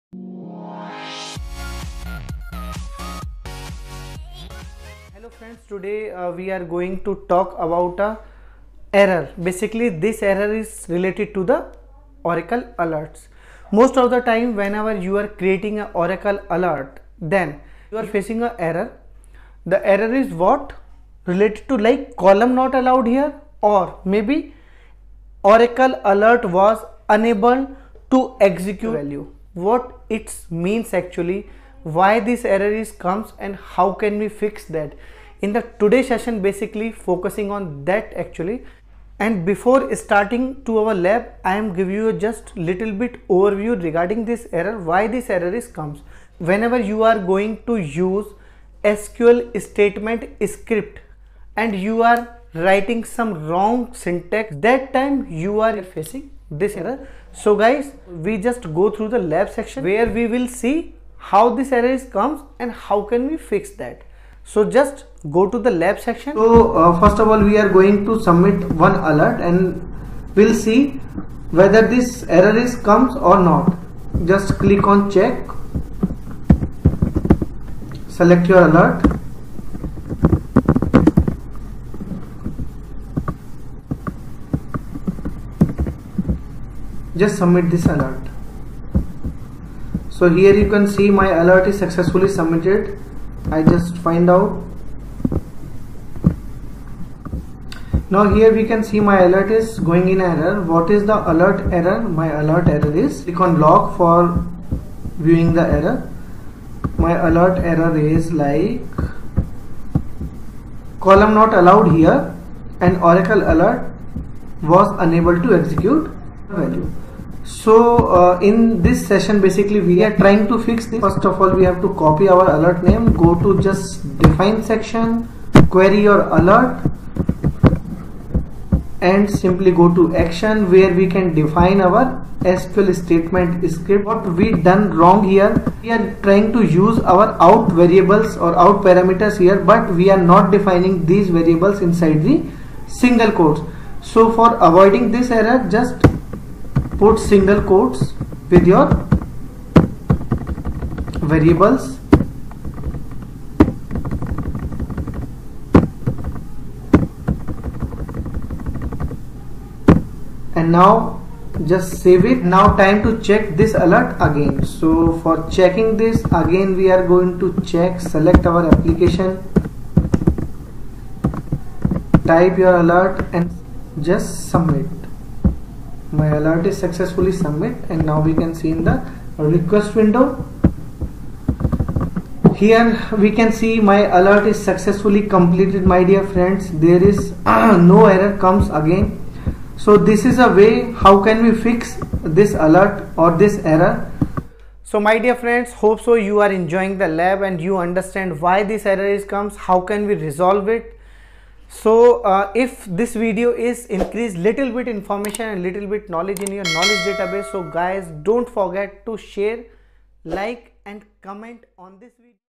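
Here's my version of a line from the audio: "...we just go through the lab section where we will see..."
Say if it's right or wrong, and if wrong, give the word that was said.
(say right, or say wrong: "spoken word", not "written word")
right.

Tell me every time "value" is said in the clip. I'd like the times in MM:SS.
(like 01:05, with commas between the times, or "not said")
00:29, 01:56.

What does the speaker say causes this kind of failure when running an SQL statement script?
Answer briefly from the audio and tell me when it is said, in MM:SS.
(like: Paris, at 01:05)
wrong syntax, at 00:53.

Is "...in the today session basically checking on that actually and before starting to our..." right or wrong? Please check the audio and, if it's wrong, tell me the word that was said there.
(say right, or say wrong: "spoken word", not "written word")
wrong: "focusing", not "checking".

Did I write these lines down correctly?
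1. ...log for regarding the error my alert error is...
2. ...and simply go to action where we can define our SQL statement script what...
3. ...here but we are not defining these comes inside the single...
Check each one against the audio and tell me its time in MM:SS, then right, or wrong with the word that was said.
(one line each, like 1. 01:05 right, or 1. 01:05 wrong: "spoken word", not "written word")
1. 01:43 wrong: "viewing", not "regarding"
2. 02:09 right
3. 02:19 wrong: "variables", not "comes".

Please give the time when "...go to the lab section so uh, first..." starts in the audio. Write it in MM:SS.
01:05.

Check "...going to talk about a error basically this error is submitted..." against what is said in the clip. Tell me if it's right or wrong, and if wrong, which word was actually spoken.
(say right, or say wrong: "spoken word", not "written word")
wrong: "related", not "submitted".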